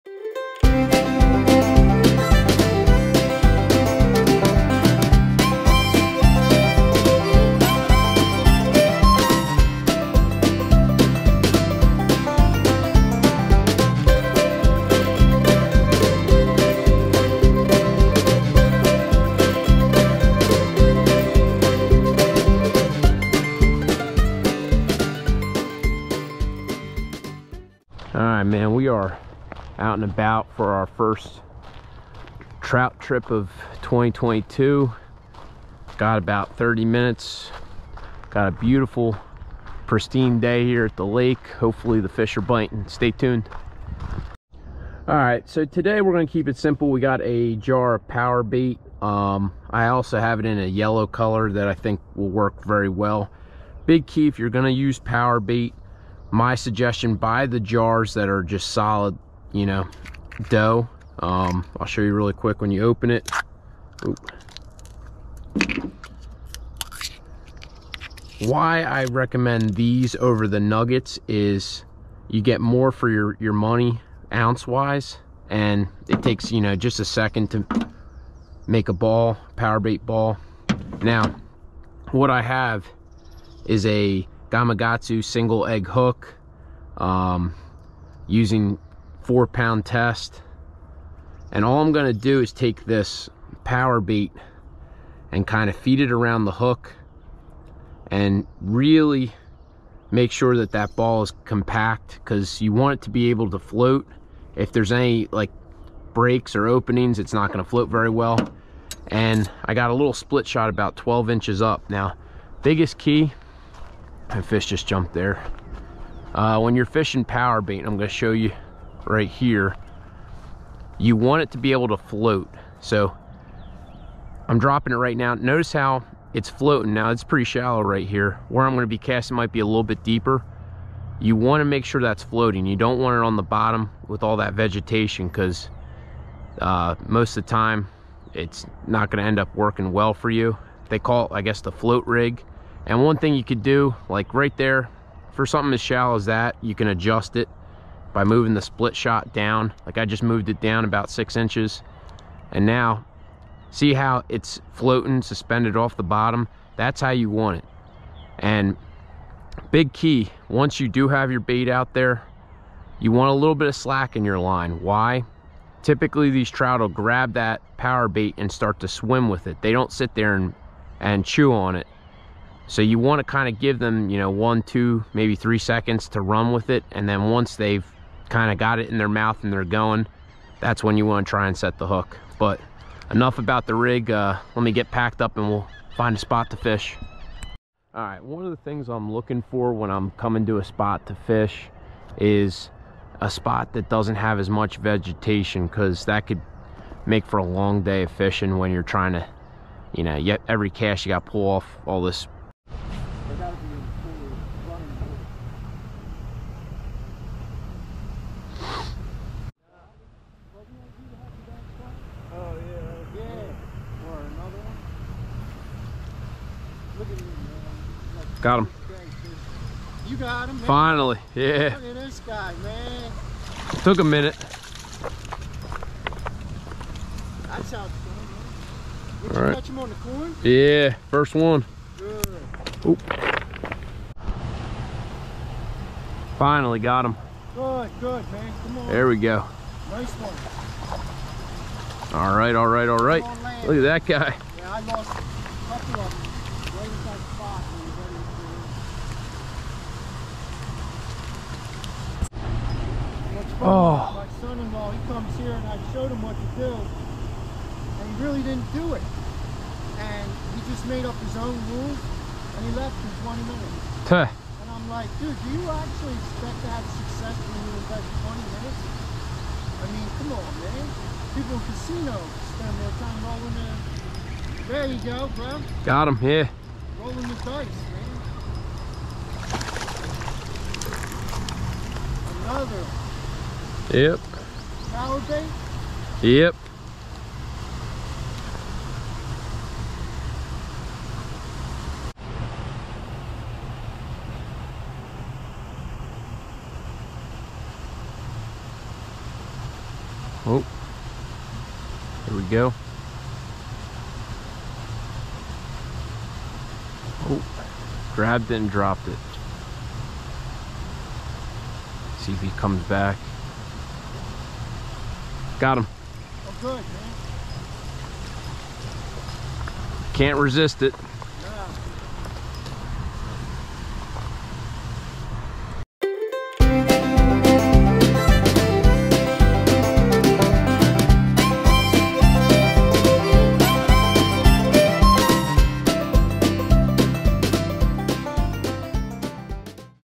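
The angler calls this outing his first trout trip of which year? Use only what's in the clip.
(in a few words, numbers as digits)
2022.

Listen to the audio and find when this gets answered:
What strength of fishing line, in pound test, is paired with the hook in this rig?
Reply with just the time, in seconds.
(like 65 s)
89 s.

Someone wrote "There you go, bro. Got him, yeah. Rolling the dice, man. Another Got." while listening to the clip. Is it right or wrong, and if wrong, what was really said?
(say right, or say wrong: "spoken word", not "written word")
wrong: "Yep", not "Got".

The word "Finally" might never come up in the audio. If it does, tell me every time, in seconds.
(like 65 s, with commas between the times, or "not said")
220 s, 236 s.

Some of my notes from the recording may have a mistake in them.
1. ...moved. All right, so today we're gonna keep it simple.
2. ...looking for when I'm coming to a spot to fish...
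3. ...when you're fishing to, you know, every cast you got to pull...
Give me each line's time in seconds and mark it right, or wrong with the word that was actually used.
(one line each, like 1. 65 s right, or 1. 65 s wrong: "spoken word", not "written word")
1. 43 s wrong: "tuned", not "moved"
2. 189 s right
3. 198 s wrong: "trying", not "fishing".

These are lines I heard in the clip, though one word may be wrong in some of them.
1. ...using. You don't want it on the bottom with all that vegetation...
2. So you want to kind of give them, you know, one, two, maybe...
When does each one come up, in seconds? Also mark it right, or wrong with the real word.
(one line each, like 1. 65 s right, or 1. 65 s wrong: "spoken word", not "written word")
1. 132 s wrong: "floating", not "using"
2. 172 s right.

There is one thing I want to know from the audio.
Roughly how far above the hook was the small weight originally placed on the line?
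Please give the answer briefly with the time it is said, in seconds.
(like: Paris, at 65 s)
12 inches, at 110 s.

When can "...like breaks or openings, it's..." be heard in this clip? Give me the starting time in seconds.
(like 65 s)
105 s.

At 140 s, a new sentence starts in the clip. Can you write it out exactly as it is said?
They call it, I guess, the float rig.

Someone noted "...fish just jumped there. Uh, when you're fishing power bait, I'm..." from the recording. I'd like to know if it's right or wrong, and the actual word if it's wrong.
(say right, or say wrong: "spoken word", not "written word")
right.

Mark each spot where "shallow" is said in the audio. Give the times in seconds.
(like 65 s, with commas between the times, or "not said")
127 s, 145 s.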